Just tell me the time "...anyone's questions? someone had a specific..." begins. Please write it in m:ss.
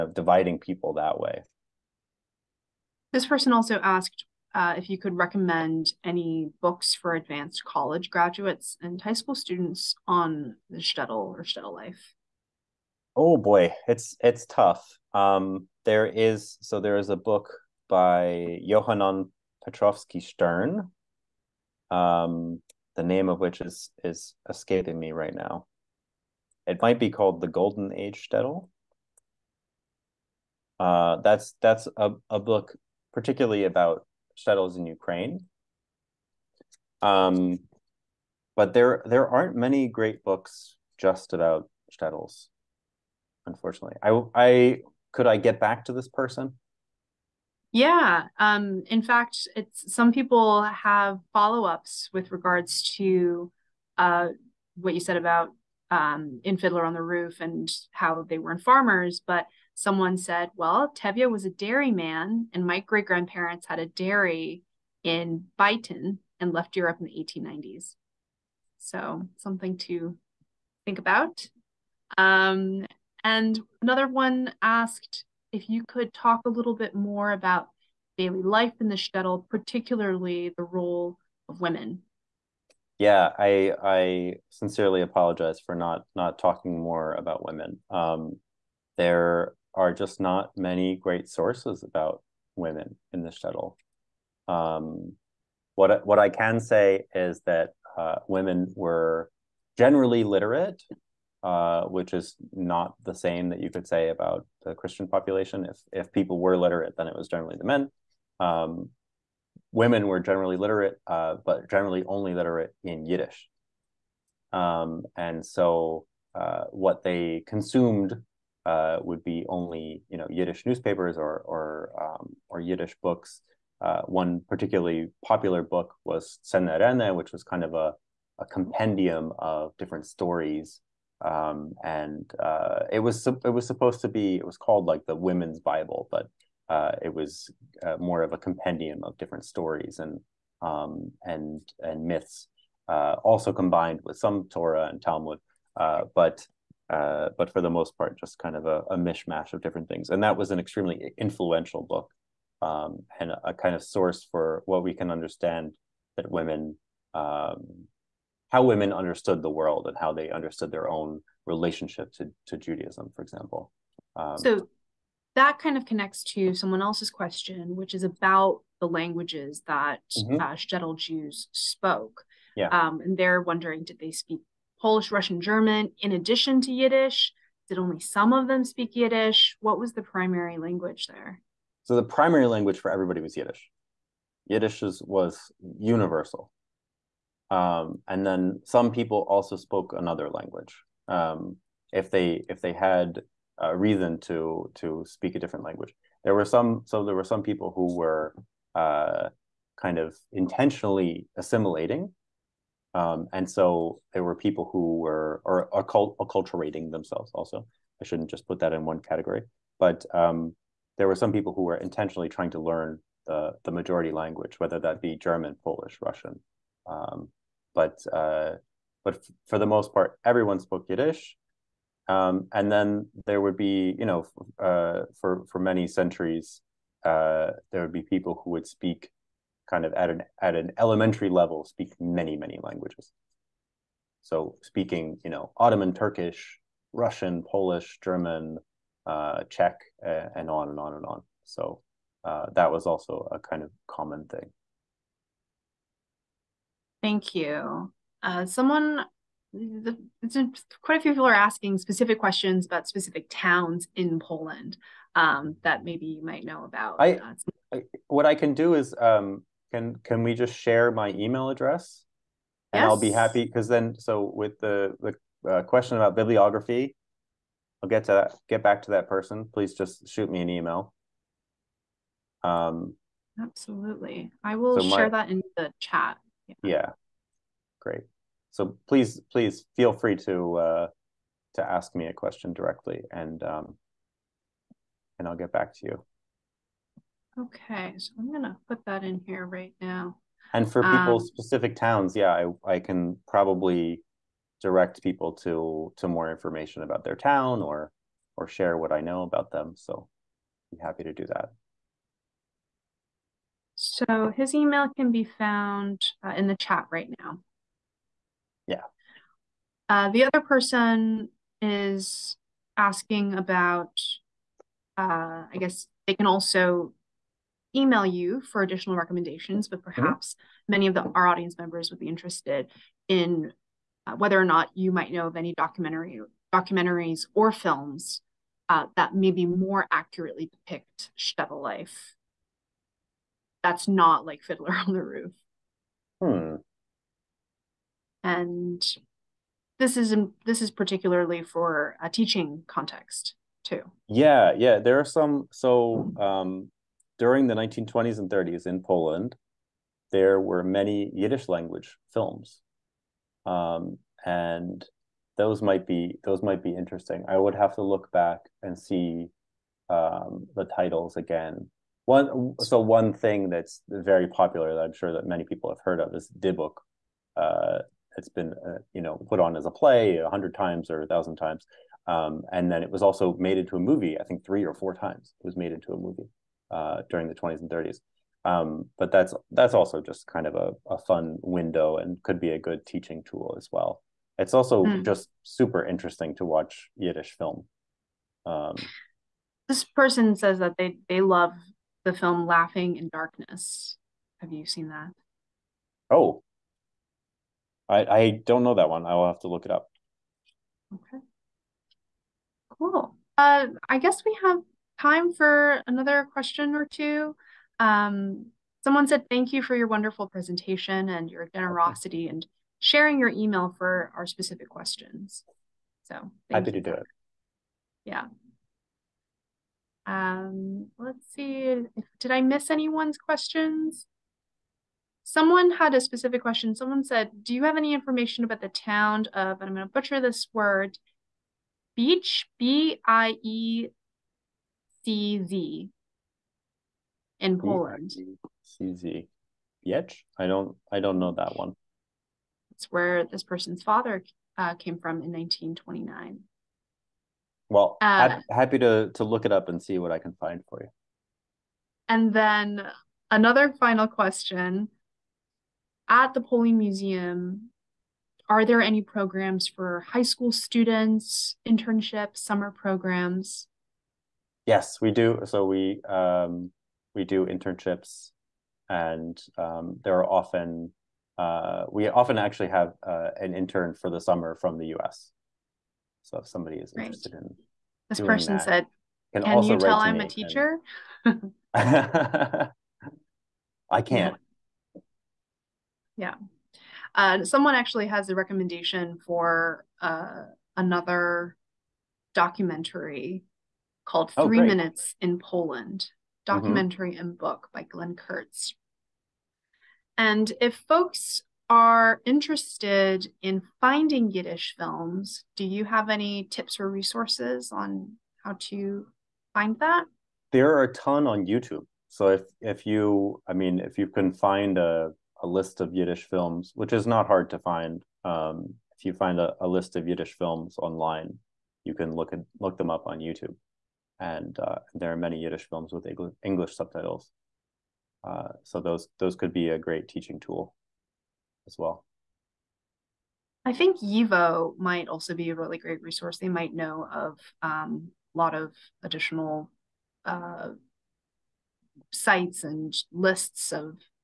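7:02.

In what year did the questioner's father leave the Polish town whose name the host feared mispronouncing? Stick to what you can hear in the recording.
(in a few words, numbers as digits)
1929.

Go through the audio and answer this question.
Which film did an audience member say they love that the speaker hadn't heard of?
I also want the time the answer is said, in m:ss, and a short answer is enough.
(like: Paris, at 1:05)
Laughing in Darkness, at 6:32.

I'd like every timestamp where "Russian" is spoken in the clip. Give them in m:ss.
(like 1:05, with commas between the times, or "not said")
2:55, 3:36, 3:56.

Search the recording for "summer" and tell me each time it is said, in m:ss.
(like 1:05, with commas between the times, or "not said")
7:42, 7:54.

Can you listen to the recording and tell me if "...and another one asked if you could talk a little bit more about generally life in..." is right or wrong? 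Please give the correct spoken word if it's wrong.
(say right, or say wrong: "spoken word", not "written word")
wrong: "daily", not "generally".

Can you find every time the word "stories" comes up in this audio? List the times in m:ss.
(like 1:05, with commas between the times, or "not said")
2:10, 2:19.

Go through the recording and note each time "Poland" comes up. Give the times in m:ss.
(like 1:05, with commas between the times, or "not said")
4:14, 5:48, 7:17, 8:15.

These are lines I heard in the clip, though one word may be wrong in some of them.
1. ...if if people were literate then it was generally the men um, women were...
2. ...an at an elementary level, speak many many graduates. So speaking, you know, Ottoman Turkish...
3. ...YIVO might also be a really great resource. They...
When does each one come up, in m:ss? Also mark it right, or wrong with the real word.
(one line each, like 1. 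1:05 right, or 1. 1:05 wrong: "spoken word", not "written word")
1. 1:45 right
2. 3:50 wrong: "languages", not "graduates"
3. 8:54 right.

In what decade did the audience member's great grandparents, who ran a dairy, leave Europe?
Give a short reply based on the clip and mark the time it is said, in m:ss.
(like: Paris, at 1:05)
1890s, at 1:07.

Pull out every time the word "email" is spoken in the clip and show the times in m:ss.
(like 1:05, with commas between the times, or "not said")
4:21, 4:30, 5:04, 5:17, 6:53.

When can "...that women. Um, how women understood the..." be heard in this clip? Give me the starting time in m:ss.
2:36.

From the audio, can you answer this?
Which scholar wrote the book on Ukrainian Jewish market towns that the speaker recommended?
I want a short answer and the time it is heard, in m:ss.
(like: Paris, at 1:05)
Johann Petrovsky-Shtern, at 0:18.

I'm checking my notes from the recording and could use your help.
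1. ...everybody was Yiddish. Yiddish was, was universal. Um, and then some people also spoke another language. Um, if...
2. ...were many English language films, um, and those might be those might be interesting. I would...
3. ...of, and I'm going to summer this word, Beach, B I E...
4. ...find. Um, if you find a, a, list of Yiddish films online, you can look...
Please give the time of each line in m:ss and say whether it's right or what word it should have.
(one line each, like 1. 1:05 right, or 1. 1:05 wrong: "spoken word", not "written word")
1. 3:02 right
2. 5:50 wrong: "Yiddish", not "English"
3. 7:09 wrong: "butcher", not "summer"
4. 8:37 right.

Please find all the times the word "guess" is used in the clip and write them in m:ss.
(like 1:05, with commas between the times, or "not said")
5:15, 6:43.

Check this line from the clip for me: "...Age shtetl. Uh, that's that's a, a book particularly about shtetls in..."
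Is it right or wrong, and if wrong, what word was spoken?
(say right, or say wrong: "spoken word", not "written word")
right.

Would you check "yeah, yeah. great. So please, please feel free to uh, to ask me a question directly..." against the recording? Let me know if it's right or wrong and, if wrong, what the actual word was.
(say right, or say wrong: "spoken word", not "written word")
right.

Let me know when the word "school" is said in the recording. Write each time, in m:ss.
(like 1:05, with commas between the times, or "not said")
0:09, 7:40.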